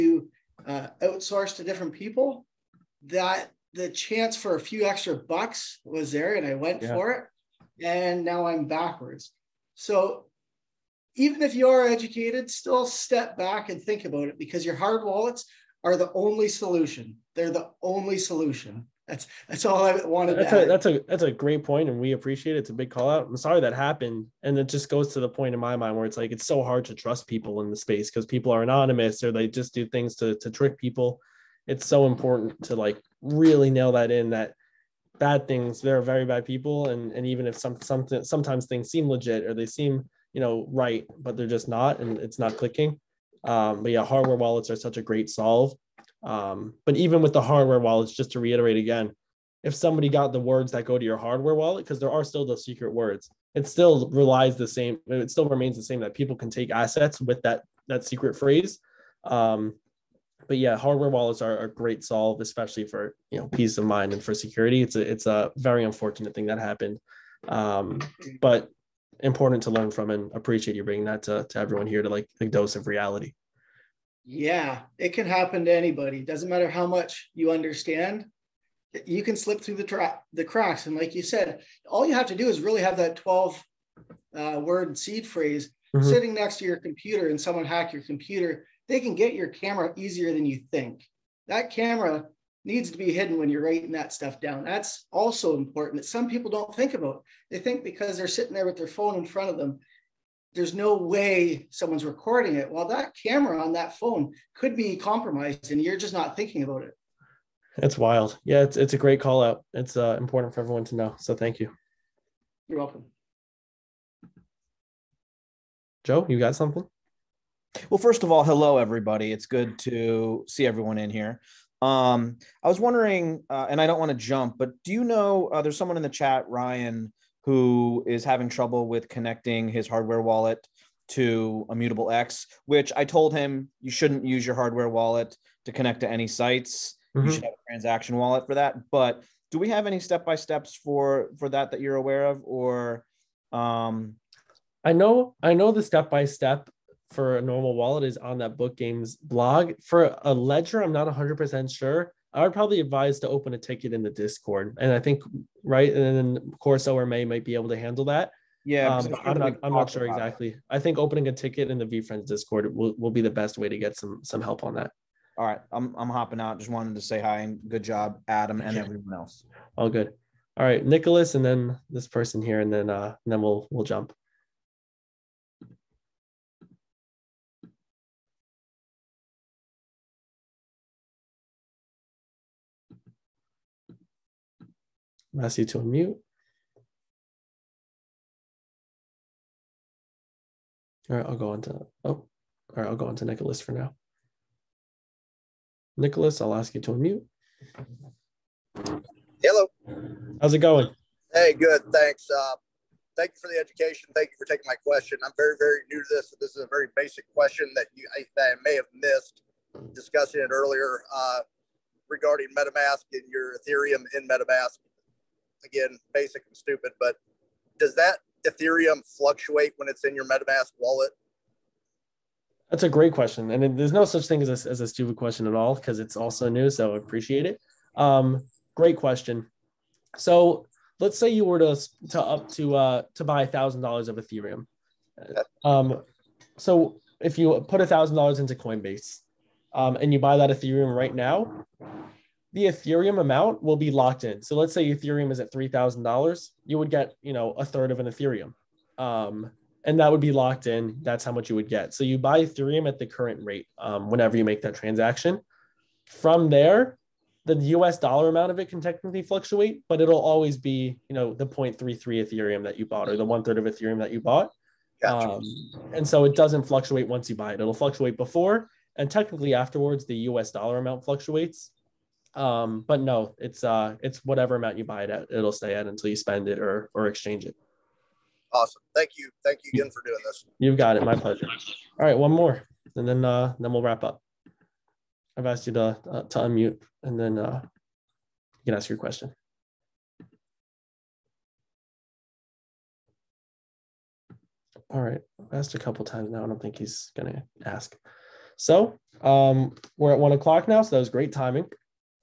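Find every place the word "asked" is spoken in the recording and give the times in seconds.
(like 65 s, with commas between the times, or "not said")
285 s, 295 s.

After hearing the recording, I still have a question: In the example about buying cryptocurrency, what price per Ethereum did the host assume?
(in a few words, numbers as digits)
$3,000.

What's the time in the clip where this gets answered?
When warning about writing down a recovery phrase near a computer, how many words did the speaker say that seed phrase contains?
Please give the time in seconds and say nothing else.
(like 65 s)
83 s.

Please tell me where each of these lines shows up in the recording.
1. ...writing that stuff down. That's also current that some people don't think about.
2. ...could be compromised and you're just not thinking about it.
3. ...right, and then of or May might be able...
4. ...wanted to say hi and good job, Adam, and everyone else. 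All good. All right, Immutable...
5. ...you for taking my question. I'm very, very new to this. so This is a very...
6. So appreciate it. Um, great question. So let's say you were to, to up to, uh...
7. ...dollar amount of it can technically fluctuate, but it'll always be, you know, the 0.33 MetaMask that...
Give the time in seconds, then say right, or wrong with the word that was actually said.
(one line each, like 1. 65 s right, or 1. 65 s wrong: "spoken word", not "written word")
1. 93 s wrong: "important", not "current"
2. 104 s right
3. 155 s right
4. 166 s wrong: "Nicholas", not "Immutable"
5. 204 s right
6. 226 s right
7. 257 s wrong: "Ethereum", not "MetaMask".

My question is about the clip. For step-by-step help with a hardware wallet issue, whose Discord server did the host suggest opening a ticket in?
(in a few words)
VeeFriends.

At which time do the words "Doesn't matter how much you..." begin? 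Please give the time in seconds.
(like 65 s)
76 s.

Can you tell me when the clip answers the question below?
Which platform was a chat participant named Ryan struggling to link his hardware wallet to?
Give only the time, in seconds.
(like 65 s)
131 s.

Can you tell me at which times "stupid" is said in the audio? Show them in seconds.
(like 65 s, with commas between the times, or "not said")
216 s, 224 s.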